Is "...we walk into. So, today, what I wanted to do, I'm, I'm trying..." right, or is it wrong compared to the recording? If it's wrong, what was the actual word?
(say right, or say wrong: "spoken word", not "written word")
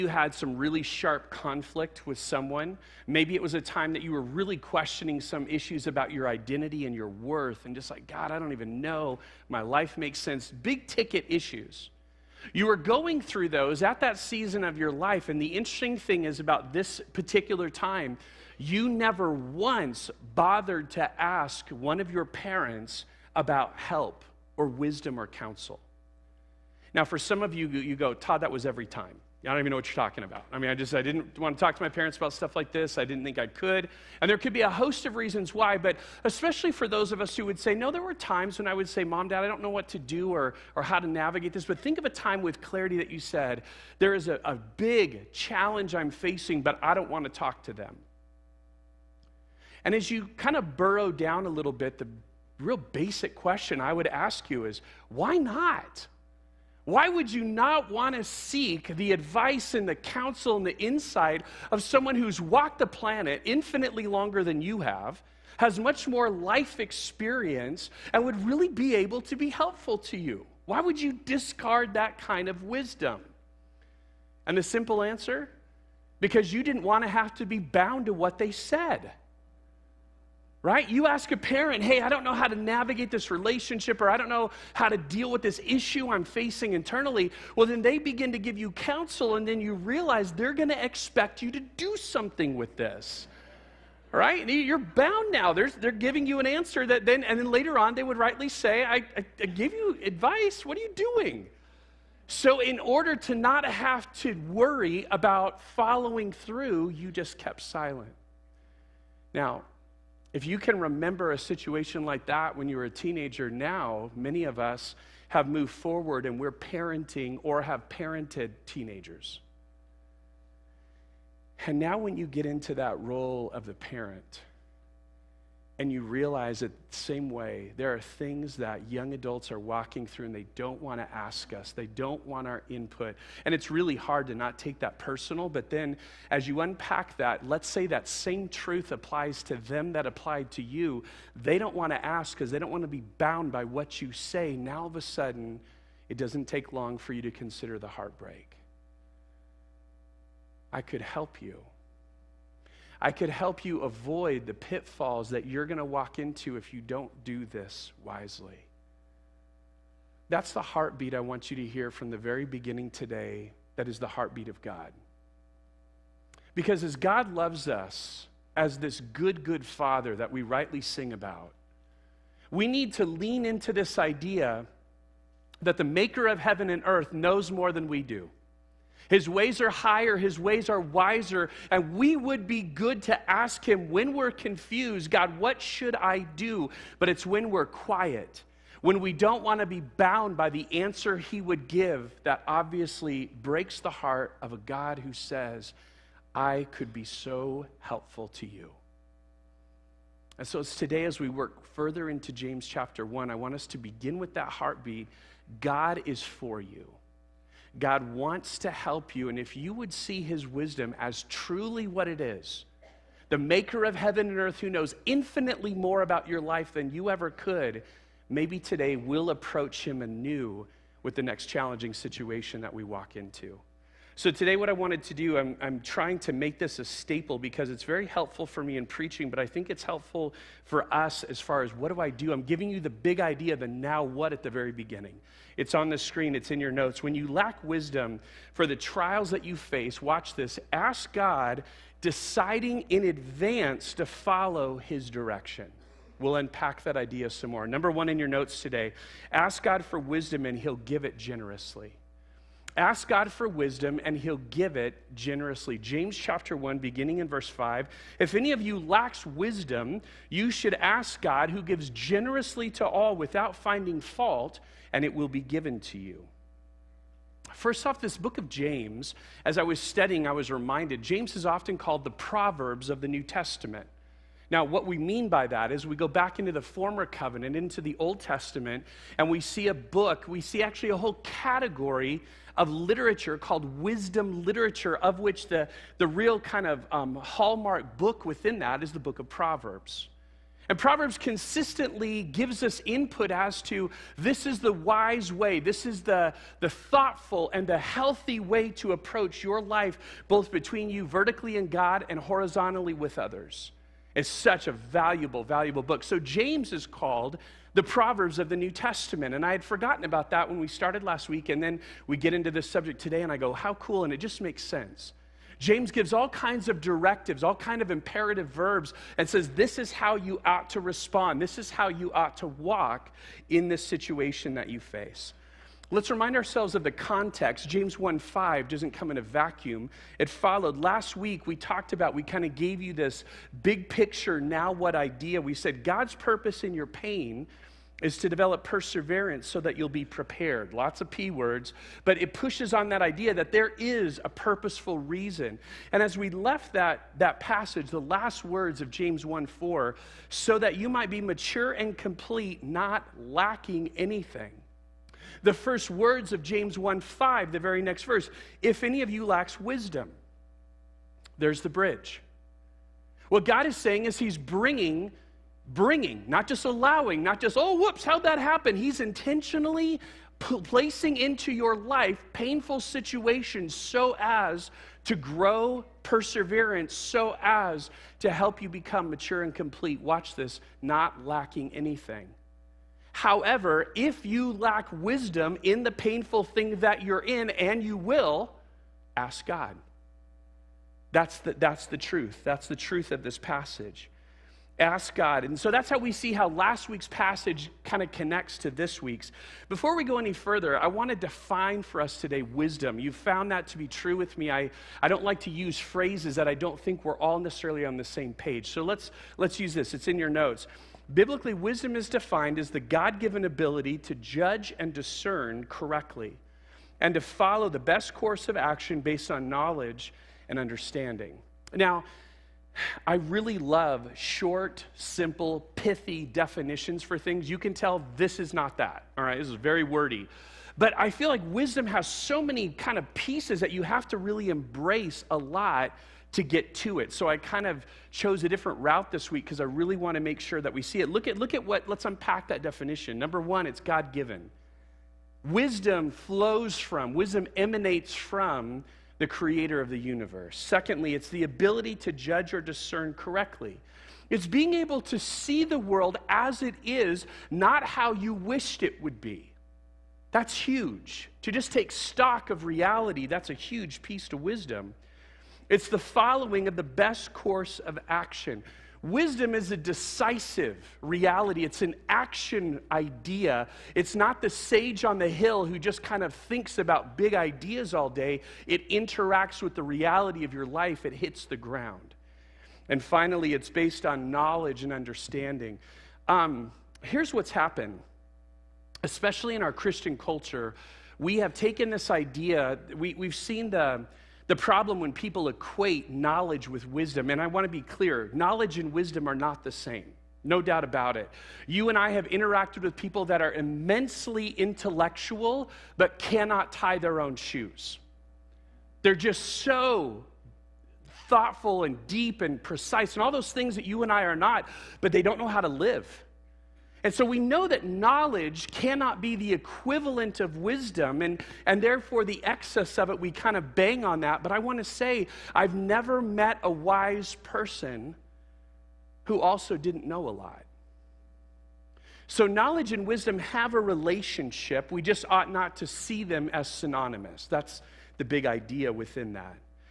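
right.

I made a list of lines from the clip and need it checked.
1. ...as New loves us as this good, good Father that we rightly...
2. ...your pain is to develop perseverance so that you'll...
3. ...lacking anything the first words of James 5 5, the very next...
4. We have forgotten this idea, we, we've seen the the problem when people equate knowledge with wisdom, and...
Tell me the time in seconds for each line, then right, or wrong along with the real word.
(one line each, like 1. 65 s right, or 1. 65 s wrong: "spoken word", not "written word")
1. 166 s wrong: "God", not "New"
2. 336 s right
3. 353 s wrong: "1", not "5"
4. 491 s wrong: "taken", not "forgotten".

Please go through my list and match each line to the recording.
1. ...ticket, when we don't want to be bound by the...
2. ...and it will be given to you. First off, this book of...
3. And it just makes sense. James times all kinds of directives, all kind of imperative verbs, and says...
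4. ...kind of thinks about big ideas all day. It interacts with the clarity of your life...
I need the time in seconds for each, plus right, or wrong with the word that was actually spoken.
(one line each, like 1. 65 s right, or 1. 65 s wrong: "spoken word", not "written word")
1. 187 s wrong: "quiet", not "ticket"
2. 264 s right
3. 314 s wrong: "gives", not "times"
4. 476 s wrong: "reality", not "clarity".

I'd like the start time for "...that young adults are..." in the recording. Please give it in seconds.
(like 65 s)
128 s.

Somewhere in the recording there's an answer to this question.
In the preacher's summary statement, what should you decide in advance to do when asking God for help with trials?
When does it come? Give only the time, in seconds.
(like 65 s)
244 s.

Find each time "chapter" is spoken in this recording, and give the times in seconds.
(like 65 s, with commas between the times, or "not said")
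202 s, 256 s.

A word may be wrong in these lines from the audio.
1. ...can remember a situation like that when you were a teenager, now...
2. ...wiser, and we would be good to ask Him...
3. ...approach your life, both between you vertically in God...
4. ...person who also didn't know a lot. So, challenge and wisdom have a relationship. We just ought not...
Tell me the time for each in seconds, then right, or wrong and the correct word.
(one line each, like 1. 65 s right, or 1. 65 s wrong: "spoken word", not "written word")
1. 110 s right
2. 180 s right
3. 298 s right
4. 527 s wrong: "knowledge", not "challenge".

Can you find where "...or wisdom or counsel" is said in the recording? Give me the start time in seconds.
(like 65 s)
24 s.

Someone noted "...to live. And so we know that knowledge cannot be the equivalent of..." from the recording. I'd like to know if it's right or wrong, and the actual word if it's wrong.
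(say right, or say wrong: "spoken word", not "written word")
right.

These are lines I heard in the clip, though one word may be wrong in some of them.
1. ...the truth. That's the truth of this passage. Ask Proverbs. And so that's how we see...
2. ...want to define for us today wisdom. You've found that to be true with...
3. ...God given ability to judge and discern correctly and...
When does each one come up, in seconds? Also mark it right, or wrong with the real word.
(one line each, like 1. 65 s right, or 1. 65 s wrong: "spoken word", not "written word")
1. 391 s wrong: "God", not "Proverbs"
2. 400 s right
3. 412 s right.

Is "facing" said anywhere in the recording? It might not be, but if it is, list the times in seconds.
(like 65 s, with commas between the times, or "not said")
46 s, 86 s.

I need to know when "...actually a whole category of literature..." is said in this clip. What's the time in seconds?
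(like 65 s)
280 s.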